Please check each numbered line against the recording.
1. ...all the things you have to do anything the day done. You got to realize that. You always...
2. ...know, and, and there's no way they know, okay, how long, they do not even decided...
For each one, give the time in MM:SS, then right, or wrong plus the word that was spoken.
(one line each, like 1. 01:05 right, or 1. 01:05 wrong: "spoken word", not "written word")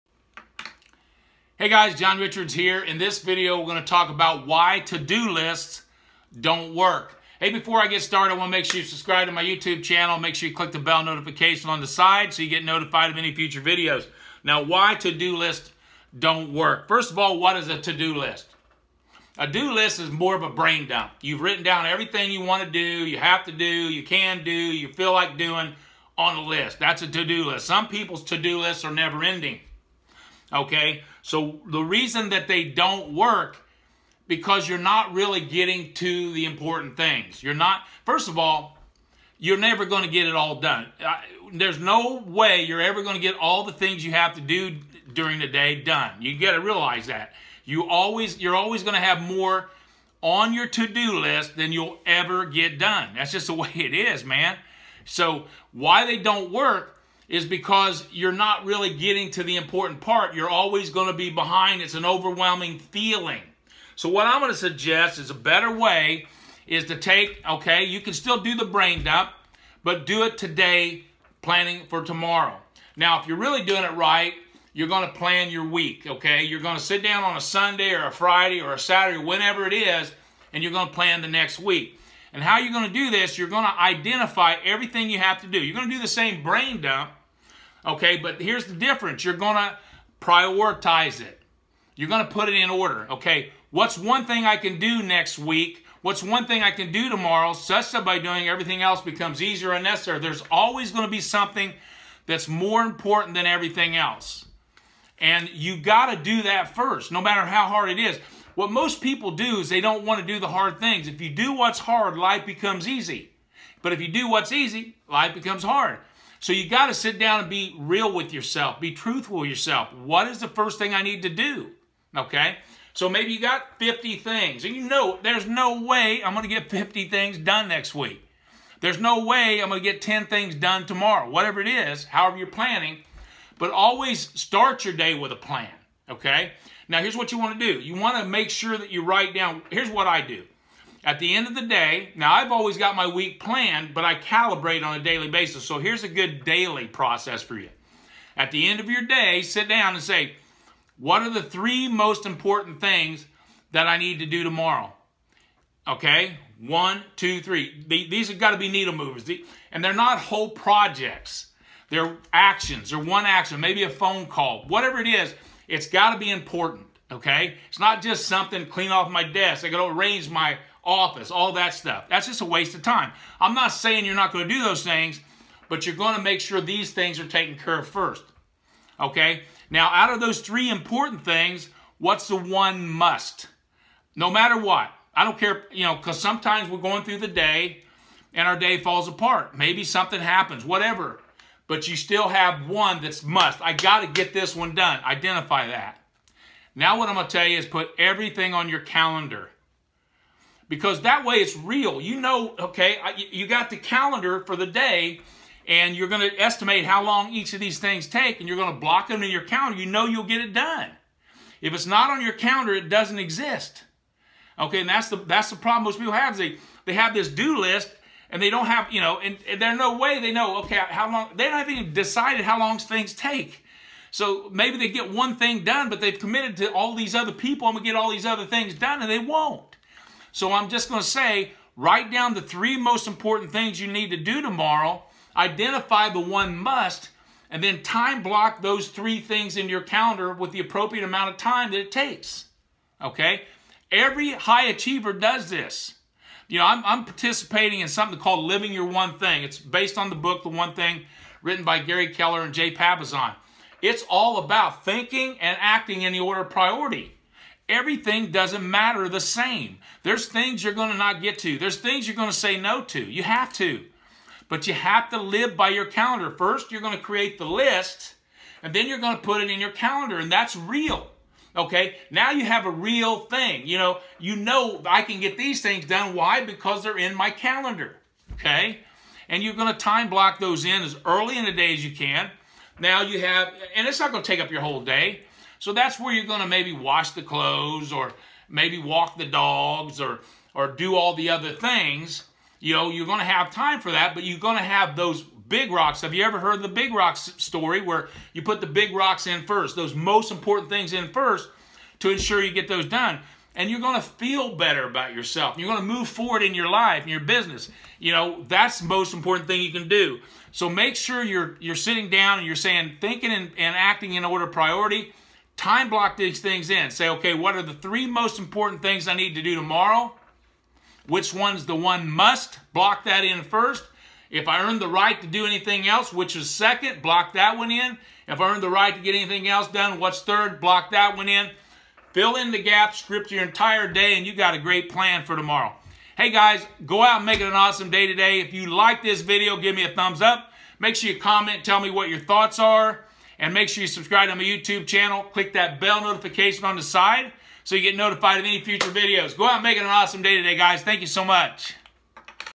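1. 00:43 wrong: "during", not "anything"
2. 03:39 right.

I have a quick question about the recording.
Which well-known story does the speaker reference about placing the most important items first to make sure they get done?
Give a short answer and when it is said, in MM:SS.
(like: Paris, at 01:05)
The big rocks story, at 04:56.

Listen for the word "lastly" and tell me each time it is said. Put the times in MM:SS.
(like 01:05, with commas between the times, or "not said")
not said.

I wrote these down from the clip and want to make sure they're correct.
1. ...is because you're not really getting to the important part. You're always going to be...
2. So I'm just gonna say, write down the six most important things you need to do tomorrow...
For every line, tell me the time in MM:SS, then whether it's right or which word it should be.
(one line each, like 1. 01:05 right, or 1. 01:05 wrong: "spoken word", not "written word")
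1. 00:57 right
2. 03:50 wrong: "three", not "six".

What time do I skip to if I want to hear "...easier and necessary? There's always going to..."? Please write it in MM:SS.
01:39.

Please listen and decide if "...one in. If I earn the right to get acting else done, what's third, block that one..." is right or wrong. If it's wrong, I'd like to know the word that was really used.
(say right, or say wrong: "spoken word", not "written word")
wrong: "anything", not "acting".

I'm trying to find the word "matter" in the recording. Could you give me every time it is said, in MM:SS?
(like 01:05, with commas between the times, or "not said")
01:47, 03:04, 04:18.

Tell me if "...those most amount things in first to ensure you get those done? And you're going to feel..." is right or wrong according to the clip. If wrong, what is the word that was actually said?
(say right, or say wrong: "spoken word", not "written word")
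wrong: "important", not "amount".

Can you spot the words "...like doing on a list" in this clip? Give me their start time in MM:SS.
00:25.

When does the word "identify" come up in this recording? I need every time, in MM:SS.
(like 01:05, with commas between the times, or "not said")
01:23, 03:15, 03:55.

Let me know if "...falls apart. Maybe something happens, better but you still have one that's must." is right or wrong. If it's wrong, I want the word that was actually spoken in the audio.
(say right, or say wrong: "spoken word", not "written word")
wrong: "whatever", not "better".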